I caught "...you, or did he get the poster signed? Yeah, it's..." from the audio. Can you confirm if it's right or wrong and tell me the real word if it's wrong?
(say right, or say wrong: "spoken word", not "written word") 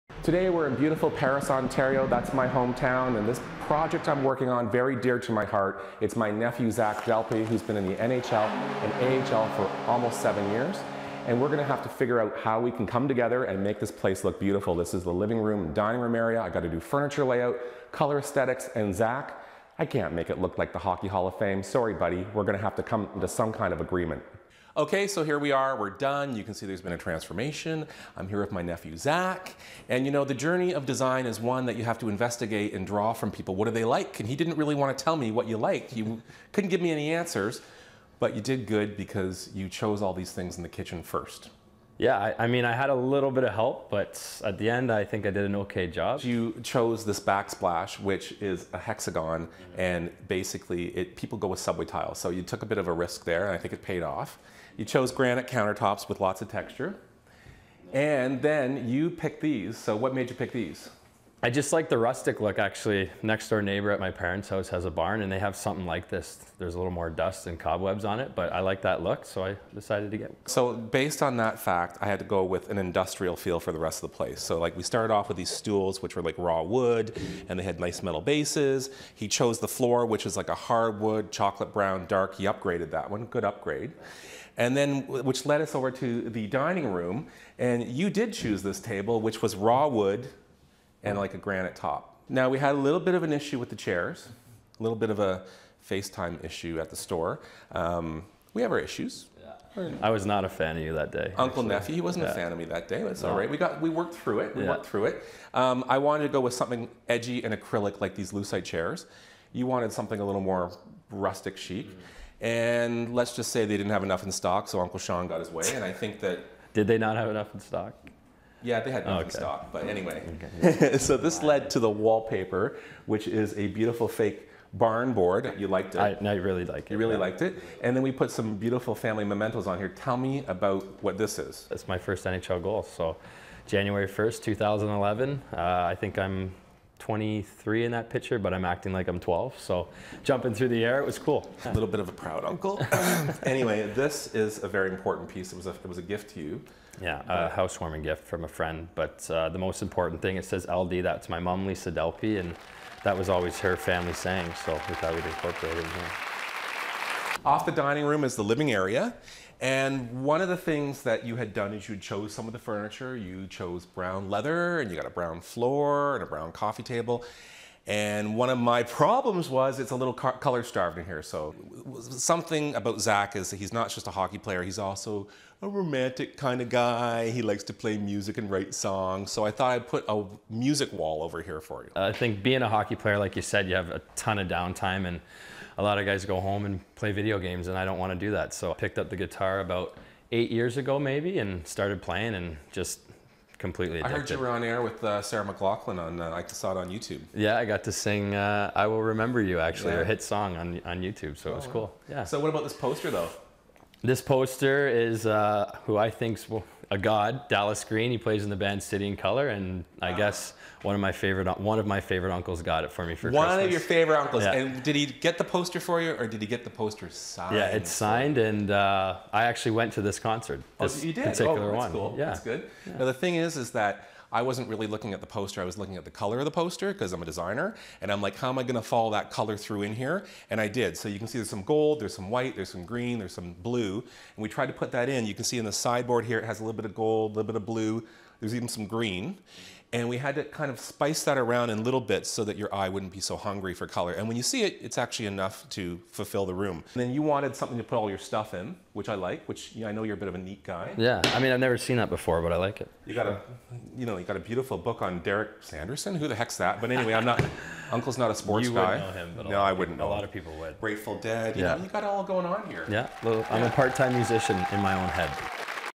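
right.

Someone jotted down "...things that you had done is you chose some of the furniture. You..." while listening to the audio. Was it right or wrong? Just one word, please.
right.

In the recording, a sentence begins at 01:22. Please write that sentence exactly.
He upgraded that one, good upgrade.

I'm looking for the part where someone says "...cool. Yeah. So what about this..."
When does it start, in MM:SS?
03:21.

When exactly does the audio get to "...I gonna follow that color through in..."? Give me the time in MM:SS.
03:48.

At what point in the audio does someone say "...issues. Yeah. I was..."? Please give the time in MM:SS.
01:38.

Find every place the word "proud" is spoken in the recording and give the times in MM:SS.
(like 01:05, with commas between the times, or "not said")
02:22.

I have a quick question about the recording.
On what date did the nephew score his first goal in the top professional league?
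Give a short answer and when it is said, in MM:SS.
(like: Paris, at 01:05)
January 1st, 2011, at 02:13.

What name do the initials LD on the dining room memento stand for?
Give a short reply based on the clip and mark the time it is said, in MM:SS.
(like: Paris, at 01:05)
Lisa Dalpe, at 02:31.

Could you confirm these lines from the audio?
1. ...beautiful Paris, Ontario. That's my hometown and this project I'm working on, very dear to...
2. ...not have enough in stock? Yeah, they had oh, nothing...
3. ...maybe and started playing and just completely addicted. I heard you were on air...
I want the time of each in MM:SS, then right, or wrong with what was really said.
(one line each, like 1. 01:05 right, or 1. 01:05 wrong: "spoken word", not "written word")
1. 00:00 right
2. 01:56 right
3. 03:10 right.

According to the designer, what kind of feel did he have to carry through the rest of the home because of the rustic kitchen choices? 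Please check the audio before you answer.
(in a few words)
Industrial.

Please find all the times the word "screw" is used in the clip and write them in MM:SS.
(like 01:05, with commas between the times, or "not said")
not said.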